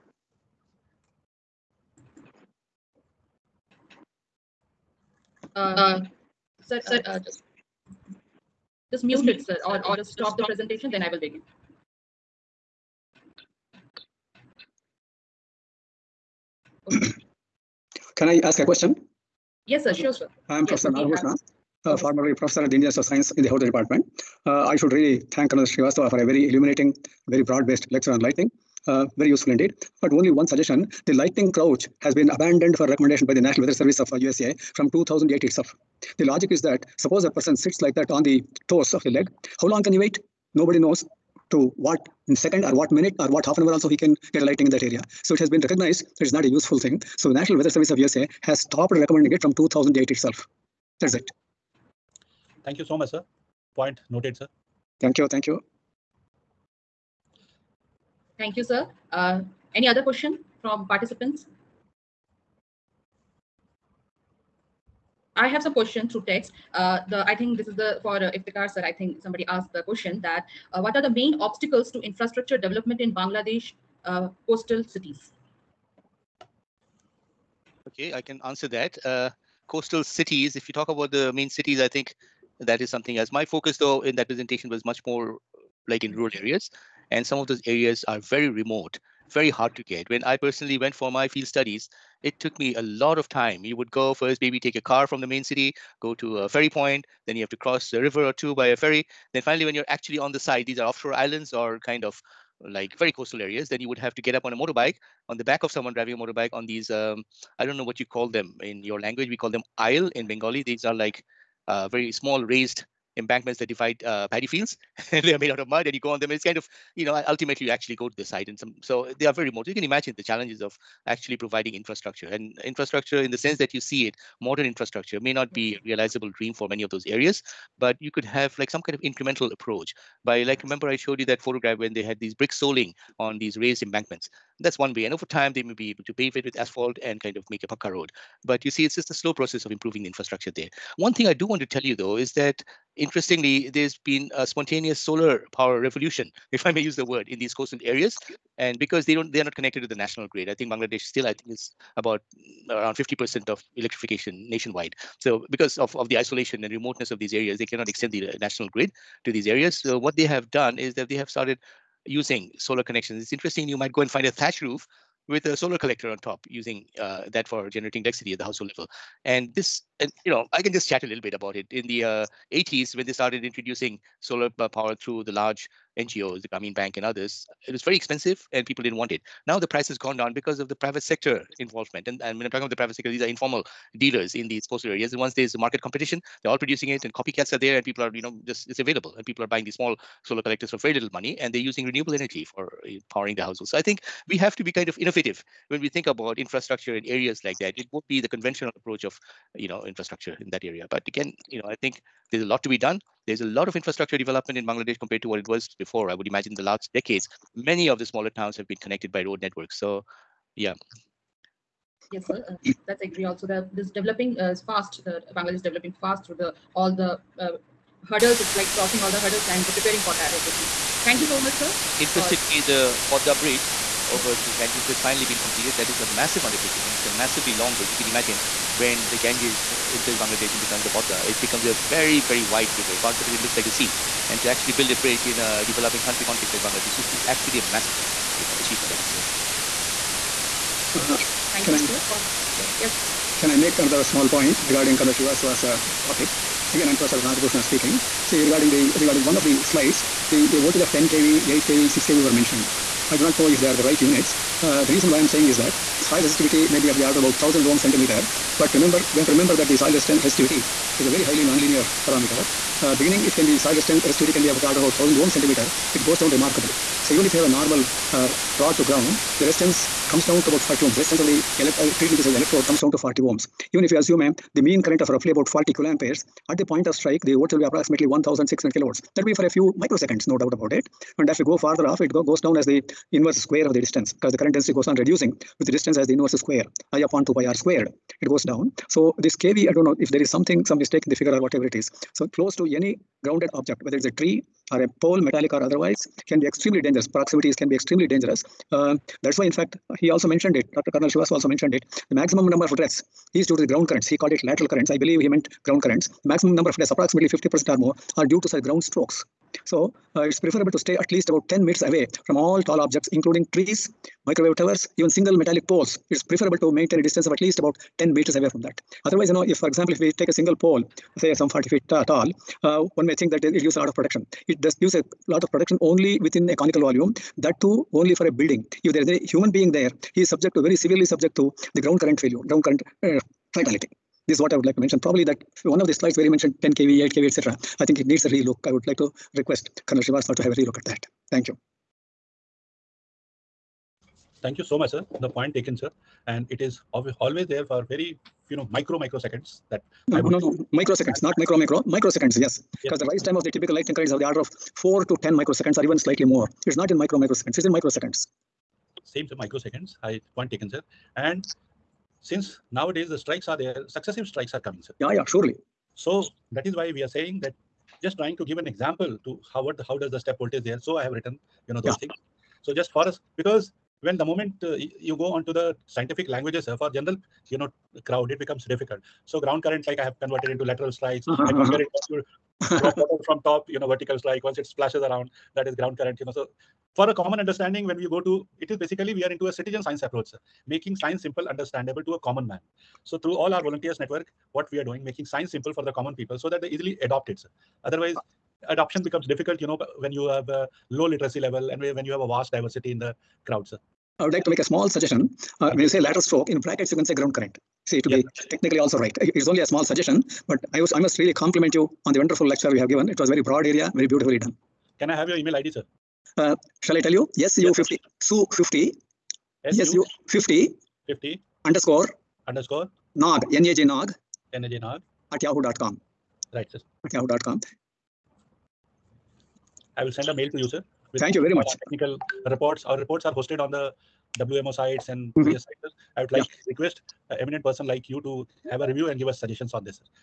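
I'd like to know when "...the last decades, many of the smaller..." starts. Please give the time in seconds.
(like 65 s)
206 s.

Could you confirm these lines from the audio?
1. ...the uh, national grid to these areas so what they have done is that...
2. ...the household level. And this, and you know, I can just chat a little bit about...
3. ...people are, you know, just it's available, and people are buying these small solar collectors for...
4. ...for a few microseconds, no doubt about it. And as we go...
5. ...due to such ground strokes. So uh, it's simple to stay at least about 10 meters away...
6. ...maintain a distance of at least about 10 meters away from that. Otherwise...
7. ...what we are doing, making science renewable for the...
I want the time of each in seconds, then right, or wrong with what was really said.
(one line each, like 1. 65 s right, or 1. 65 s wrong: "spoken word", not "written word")
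1. 158 s right
2. 168 s right
3. 187 s right
4. 279 s right
5. 308 s wrong: "preferable", not "simple"
6. 316 s right
7. 394 s wrong: "simple", not "renewable".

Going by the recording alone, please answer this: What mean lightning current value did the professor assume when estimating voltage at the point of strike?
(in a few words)
40 kiloamperes.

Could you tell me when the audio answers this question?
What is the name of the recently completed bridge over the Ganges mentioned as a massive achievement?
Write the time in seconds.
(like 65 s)
223 s.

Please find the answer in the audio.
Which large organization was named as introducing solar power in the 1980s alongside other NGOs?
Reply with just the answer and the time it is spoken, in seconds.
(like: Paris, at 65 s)
Grameen Bank, at 176 s.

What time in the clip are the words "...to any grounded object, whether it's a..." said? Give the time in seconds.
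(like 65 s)
292 s.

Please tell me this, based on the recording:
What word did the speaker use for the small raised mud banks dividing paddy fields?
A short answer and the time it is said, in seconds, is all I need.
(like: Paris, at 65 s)
isle, at 109 s.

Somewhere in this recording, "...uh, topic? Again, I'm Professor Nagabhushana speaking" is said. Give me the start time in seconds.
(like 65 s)
245 s.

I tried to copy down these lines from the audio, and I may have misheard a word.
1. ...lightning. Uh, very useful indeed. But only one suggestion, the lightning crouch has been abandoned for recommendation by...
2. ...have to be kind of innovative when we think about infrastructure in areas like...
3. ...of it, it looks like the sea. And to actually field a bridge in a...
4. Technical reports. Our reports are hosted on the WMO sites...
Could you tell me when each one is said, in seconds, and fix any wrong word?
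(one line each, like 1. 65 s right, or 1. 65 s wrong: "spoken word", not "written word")
1. 28 s right
2. 194 s right
3. 233 s wrong: "build", not "field"
4. 431 s right.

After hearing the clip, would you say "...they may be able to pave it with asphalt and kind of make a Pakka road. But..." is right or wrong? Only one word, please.
right.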